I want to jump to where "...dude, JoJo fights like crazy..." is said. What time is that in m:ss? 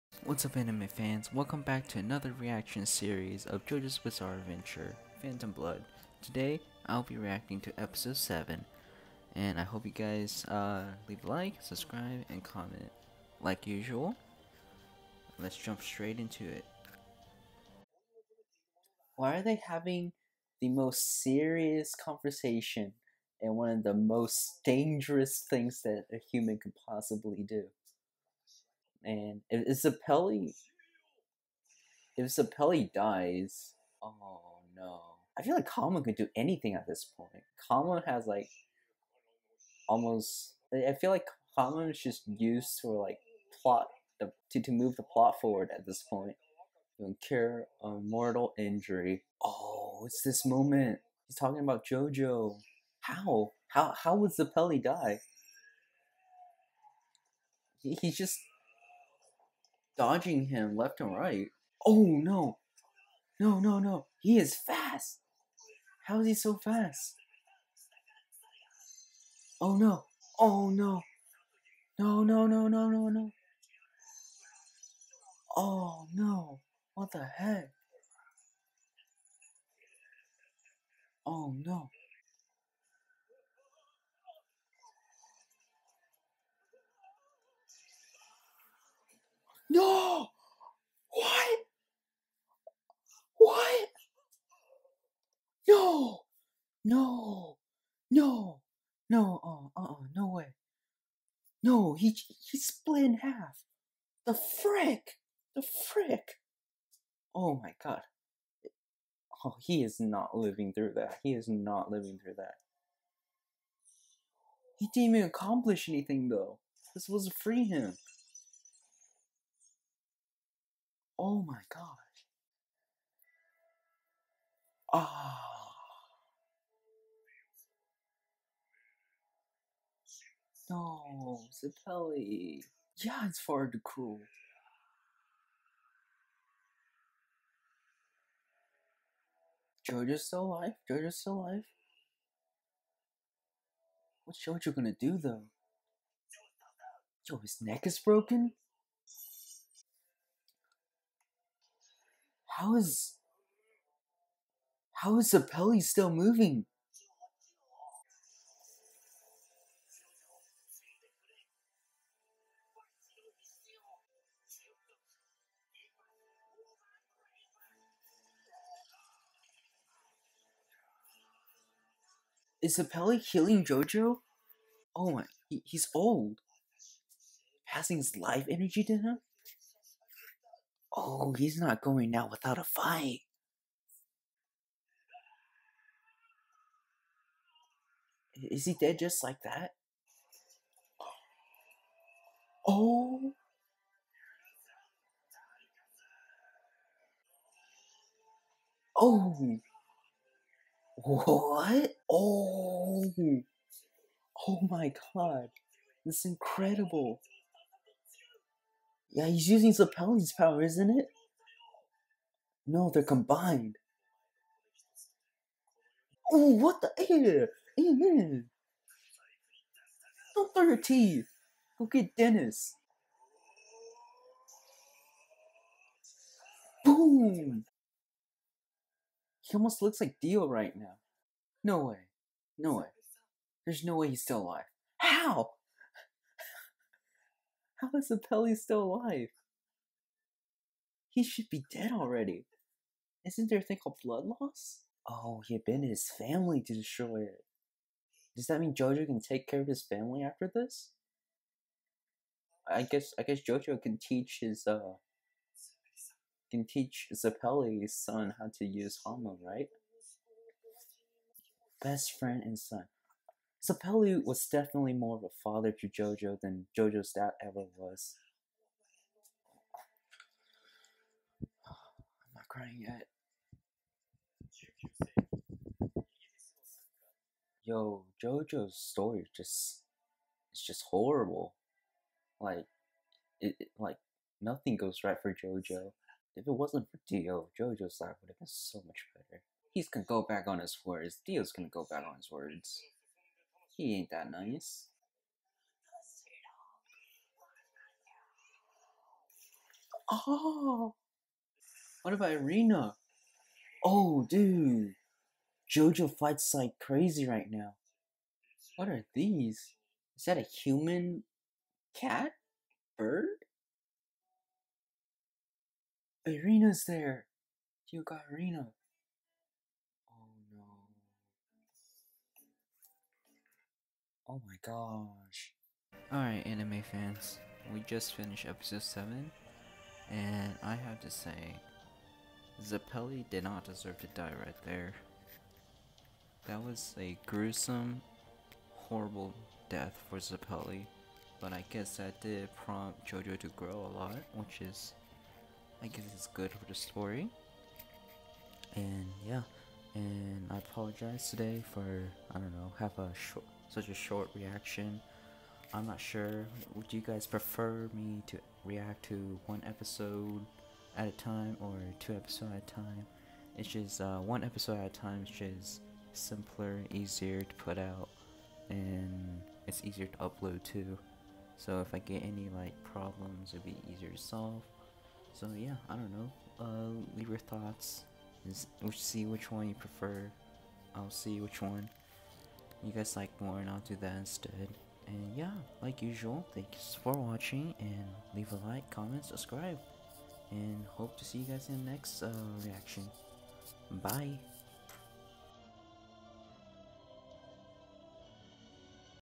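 5:04.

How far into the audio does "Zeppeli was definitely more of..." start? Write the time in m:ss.
4:23.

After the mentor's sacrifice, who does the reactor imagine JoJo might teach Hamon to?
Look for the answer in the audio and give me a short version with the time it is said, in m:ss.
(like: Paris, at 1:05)
Zeppeli's son, at 4:17.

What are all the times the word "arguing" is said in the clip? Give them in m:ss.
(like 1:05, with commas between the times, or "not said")
not said.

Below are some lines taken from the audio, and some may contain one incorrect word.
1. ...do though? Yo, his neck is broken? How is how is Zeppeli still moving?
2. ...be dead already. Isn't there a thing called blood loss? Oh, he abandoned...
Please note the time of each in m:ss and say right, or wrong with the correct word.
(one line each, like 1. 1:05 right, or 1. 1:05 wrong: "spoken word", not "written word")
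1. 2:24 right
2. 4:01 right.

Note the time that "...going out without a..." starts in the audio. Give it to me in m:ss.
3:01.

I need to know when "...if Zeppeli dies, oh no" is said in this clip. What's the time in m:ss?
0:32.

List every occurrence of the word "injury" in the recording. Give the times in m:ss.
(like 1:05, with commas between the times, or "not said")
0:48.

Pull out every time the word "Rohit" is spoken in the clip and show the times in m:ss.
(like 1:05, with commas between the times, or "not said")
not said.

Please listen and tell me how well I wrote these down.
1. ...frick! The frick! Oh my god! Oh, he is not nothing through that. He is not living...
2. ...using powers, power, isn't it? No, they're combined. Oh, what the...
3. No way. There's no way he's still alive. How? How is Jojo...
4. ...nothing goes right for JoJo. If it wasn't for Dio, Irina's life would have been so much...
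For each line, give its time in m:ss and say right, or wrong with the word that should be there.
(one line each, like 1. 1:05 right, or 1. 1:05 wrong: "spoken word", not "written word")
1. 1:44 wrong: "living", not "nothing"
2. 3:29 right
3. 3:52 wrong: "Zeppeli", not "Jojo"
4. 4:44 wrong: "JoJo", not "Irina".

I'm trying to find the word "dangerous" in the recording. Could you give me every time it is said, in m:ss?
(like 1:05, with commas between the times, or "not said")
0:24.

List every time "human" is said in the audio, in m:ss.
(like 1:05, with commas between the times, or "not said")
0:26, 5:10.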